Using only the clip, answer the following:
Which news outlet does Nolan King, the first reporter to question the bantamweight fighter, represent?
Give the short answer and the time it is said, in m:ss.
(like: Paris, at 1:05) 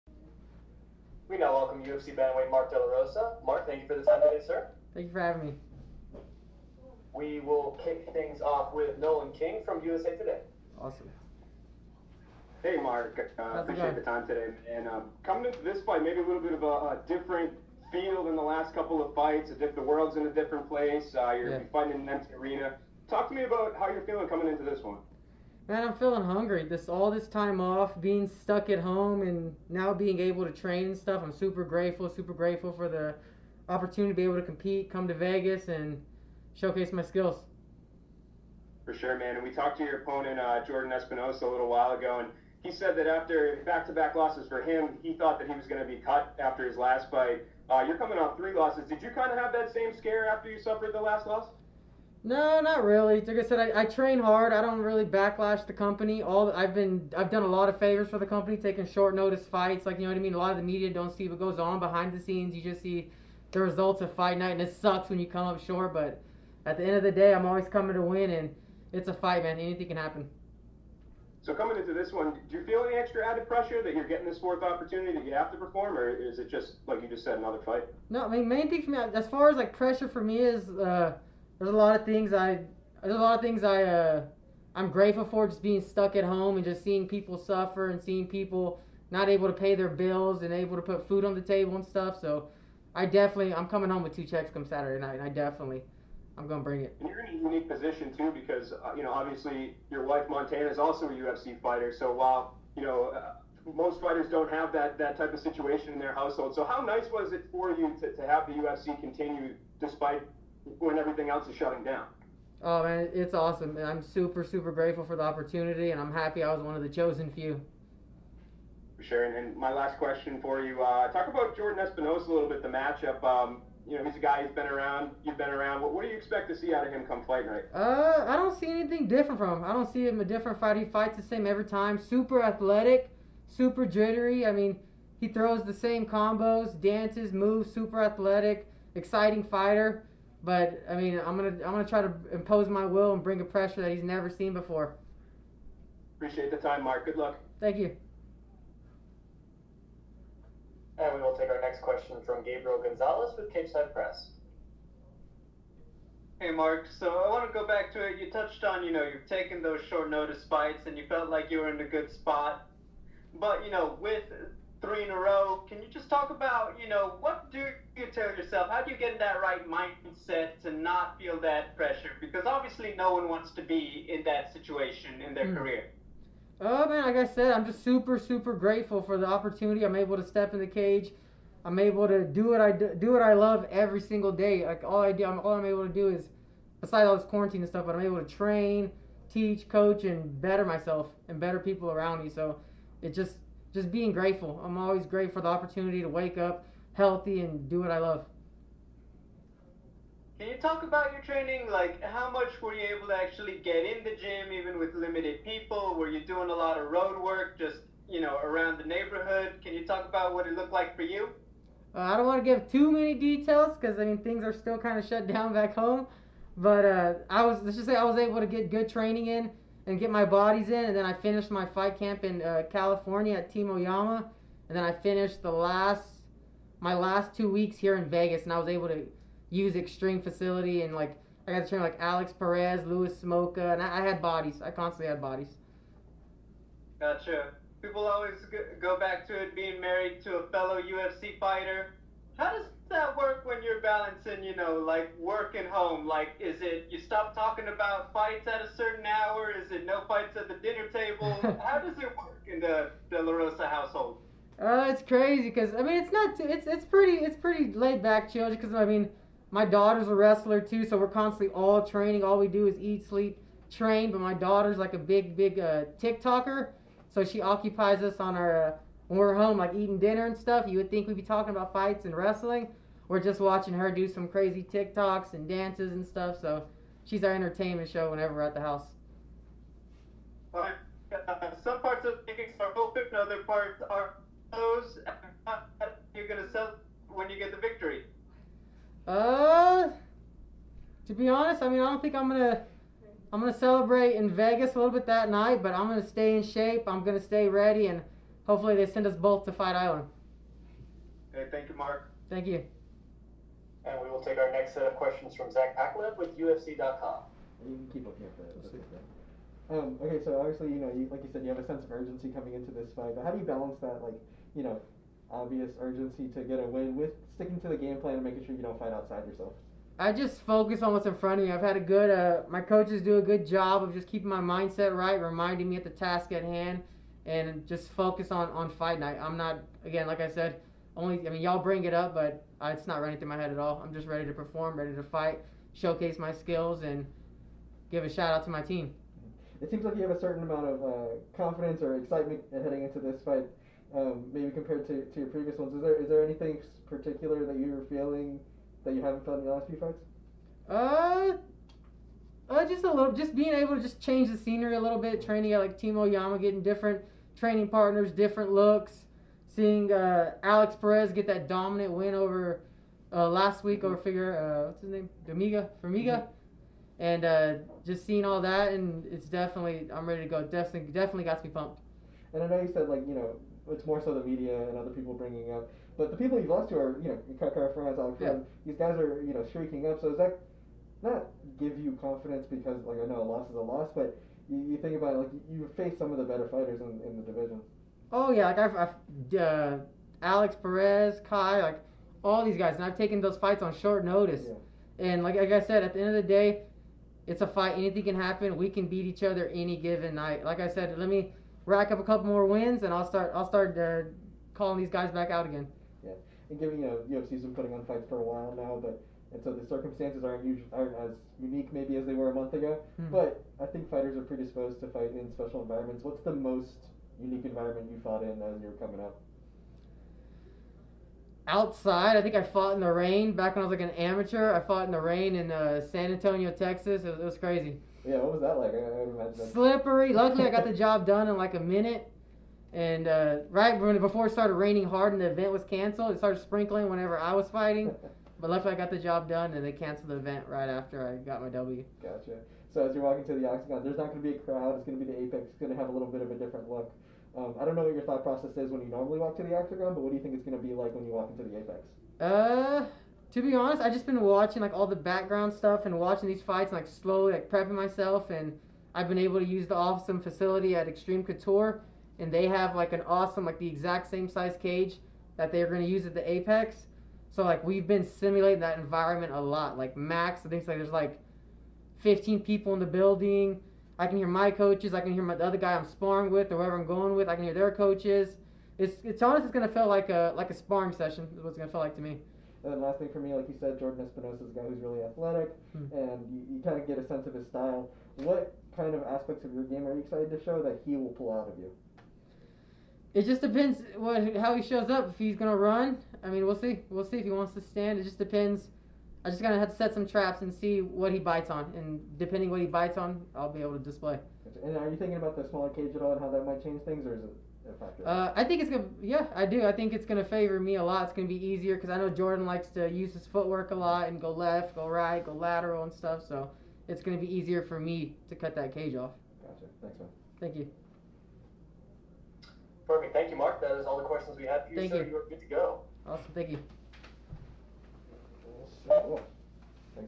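USA Today, at 0:09.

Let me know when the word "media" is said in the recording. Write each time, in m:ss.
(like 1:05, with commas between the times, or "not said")
1:00, 6:14.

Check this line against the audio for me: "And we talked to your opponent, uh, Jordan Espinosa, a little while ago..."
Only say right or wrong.
right.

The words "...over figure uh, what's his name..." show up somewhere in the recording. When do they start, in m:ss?
6:03.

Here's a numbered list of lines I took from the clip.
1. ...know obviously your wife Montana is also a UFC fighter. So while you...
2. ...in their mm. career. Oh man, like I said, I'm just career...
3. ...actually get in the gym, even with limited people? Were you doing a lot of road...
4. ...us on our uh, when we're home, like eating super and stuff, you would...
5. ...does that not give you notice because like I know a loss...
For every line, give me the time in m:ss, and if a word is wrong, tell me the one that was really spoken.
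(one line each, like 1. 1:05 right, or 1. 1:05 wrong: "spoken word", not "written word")
1. 1:39 right
2. 2:55 wrong: "super", not "career"
3. 3:23 right
4. 4:28 wrong: "dinner", not "super"
5. 6:20 wrong: "confidence", not "notice".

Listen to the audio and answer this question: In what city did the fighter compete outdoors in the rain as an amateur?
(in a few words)
San Antonio.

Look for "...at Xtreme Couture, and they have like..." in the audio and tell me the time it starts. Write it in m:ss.
7:40.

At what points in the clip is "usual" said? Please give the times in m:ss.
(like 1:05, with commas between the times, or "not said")
6:50.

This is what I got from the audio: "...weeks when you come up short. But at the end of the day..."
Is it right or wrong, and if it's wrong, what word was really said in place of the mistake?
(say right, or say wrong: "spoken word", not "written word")
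wrong: "sucks", not "weeks".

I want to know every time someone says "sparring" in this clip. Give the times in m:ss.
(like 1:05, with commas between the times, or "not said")
7:55, 8:00.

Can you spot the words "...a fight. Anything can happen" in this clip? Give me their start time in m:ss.
6:37.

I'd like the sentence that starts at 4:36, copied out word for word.
So she's our entertainment show whenever we're at the house.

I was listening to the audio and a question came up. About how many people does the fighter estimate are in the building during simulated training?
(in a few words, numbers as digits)
15.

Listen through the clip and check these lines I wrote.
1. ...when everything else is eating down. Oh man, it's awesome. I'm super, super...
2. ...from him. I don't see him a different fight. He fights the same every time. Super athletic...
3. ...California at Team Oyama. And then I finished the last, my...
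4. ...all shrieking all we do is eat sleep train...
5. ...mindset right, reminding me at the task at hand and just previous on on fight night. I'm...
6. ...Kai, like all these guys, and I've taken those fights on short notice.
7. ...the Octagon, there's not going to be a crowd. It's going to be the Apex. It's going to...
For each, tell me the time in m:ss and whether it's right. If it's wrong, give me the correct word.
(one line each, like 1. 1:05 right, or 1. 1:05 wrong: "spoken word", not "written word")
1. 1:50 wrong: "shutting", not "eating"
2. 2:09 right
3. 3:42 right
4. 4:21 wrong: "training", not "shrieking"
5. 5:24 wrong: "focus", not "previous"
6. 6:31 right
7. 7:23 right.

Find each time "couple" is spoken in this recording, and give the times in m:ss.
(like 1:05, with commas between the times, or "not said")
0:18, 6:42.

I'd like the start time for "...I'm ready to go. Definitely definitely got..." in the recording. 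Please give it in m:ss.
6:09.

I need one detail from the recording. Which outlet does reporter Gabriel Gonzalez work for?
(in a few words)
Cageside Press.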